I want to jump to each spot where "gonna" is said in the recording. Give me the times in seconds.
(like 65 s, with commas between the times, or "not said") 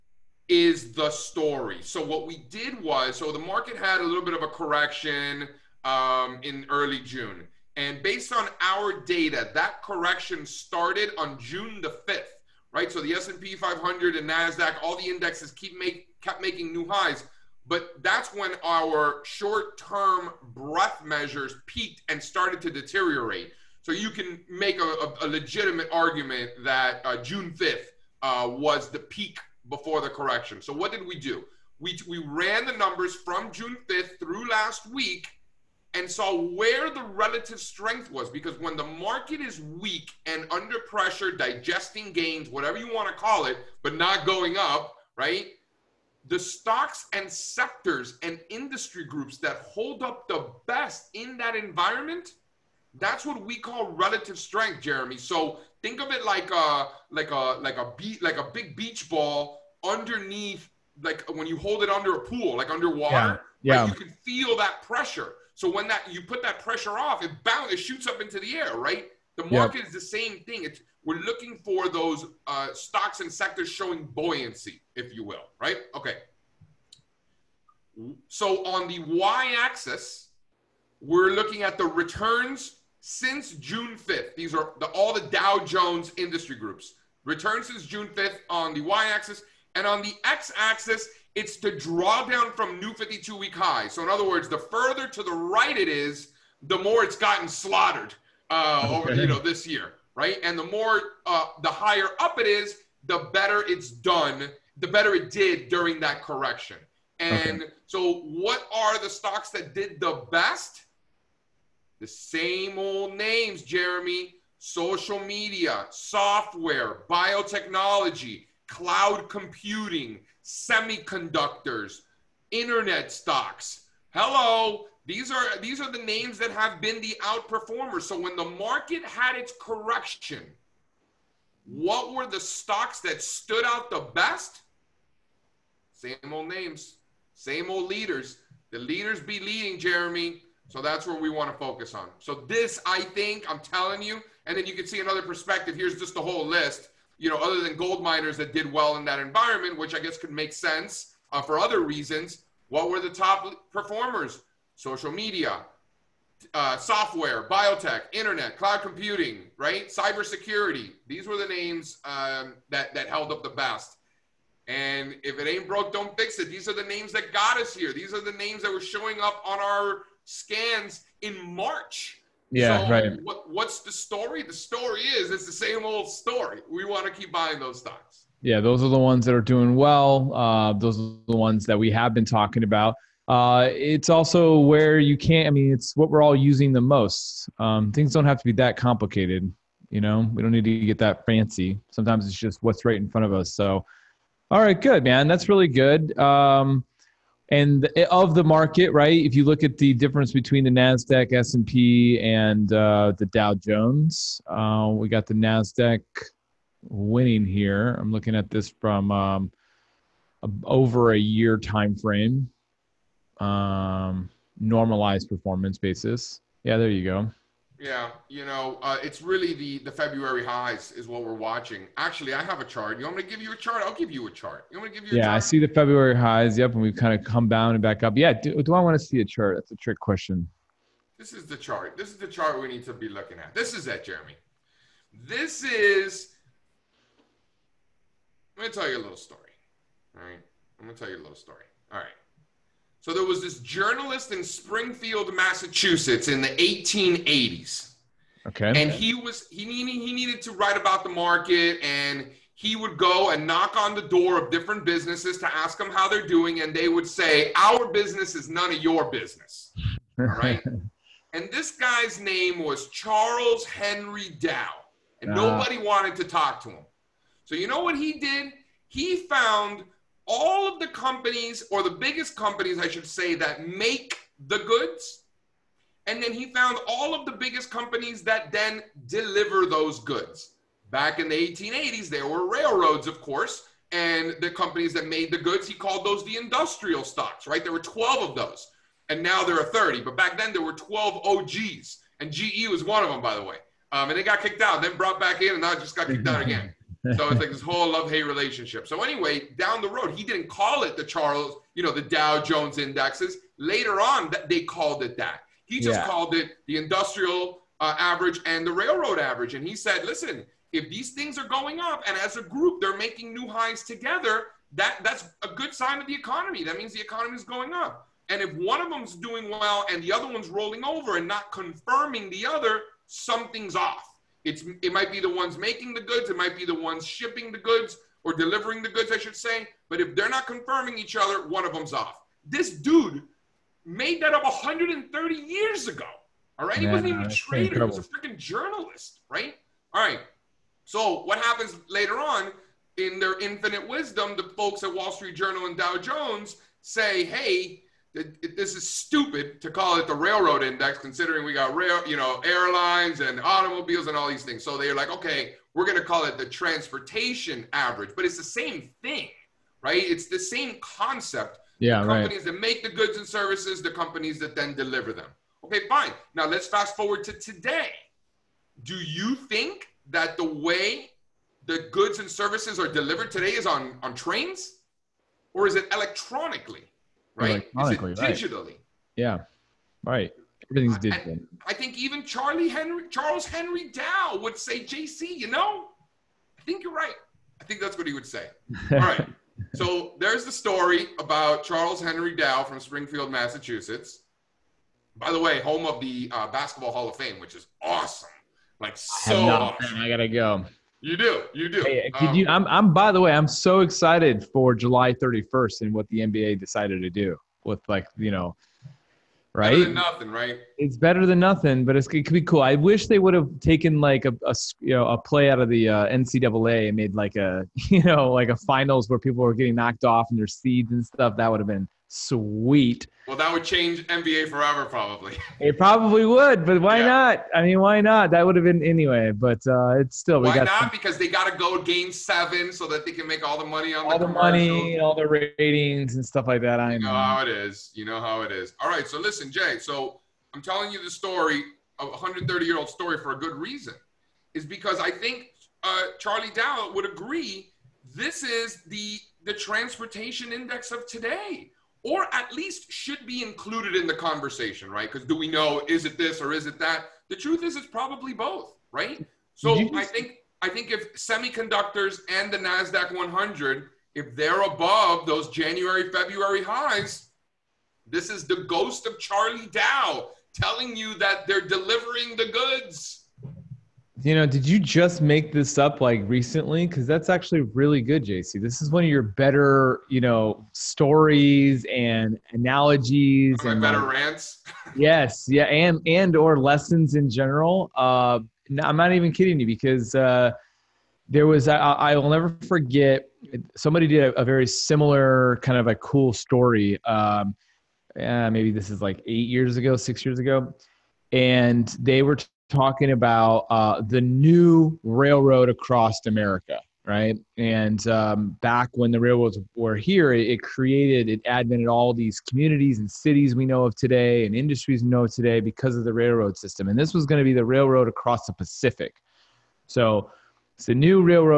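240 s.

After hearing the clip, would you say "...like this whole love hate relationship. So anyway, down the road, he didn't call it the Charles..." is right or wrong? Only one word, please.
right.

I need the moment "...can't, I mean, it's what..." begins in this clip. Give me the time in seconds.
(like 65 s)
185 s.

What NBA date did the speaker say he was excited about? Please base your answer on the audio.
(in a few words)
July 31st.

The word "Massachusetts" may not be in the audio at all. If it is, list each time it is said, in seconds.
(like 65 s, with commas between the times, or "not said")
245 s, 393 s.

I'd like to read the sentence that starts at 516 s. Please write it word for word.
And this was going to be the railroad across the Pacific.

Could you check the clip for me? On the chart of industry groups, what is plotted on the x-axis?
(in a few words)
Drawdown from new 52-week high.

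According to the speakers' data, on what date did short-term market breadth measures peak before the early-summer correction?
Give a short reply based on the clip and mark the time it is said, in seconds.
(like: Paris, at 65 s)
June 5th, at 11 s.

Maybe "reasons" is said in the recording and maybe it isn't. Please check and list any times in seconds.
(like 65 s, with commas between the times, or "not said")
151 s, 443 s.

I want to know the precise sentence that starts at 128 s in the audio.
So when the market had its correction, what were the stocks that stood out the best?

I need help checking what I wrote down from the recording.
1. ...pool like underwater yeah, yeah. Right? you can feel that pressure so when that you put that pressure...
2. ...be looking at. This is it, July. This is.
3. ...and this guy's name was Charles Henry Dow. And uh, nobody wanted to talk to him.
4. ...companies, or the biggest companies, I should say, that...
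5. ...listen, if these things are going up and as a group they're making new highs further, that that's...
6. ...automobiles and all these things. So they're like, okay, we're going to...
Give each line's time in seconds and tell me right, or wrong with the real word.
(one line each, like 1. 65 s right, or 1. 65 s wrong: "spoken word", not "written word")
1. 62 s right
2. 232 s wrong: "Jeremy", not "July"
3. 261 s right
4. 270 s right
5. 310 s wrong: "together", not "further"
6. 353 s right.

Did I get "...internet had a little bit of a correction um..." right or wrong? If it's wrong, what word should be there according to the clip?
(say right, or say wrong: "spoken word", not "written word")
wrong: "market", not "internet".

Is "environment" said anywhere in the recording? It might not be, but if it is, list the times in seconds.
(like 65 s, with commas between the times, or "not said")
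51 s, 149 s.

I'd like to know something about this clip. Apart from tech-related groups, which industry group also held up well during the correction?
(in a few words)
Gold miners.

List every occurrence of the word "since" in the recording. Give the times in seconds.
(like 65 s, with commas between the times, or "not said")
83 s, 87 s.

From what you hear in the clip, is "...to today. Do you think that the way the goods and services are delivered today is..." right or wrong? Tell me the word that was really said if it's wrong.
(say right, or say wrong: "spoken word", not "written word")
right.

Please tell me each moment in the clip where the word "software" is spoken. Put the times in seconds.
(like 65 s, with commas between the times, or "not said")
115 s, 156 s.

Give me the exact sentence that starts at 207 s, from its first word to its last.
I'm looking at this from um, over a year time frame um, normalized performance basis.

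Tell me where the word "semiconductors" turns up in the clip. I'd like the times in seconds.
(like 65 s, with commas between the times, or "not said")
120 s, 461 s.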